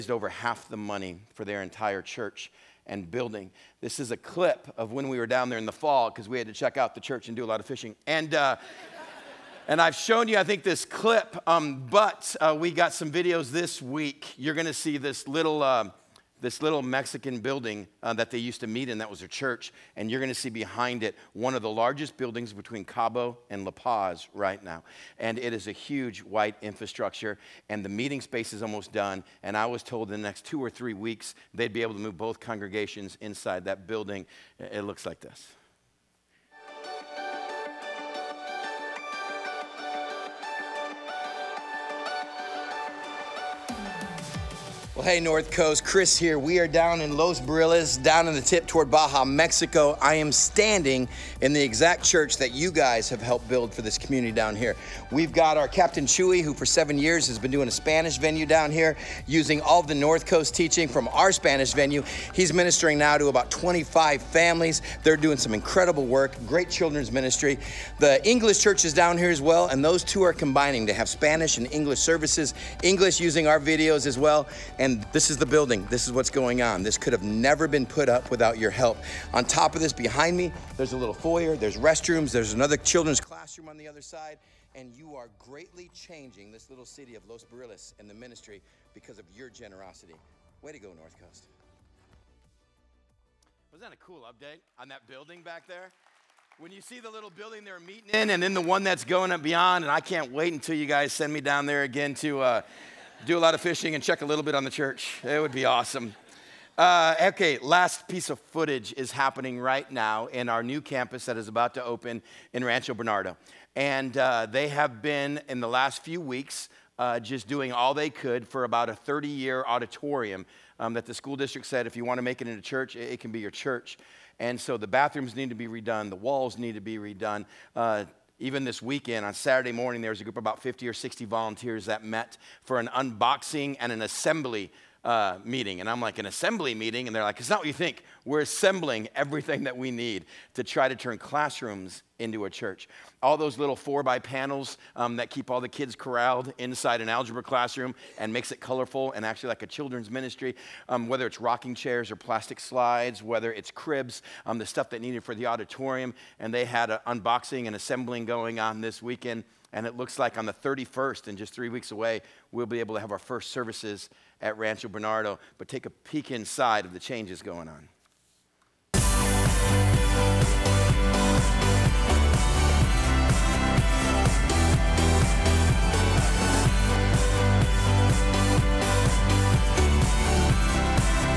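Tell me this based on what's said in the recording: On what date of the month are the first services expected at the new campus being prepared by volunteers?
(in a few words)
31st.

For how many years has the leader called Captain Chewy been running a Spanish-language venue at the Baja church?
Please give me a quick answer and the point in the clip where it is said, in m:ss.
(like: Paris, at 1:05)
7, at 0:56.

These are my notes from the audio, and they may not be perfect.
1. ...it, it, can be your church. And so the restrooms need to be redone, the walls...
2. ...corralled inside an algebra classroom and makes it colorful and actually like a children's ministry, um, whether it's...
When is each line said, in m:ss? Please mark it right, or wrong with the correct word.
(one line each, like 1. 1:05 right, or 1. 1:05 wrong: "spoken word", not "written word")
1. 2:02 wrong: "bathrooms", not "restrooms"
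2. 2:25 right.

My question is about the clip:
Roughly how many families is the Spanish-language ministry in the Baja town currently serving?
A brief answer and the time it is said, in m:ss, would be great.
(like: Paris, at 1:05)
25, at 1:03.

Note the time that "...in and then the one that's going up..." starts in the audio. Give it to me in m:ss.
1:38.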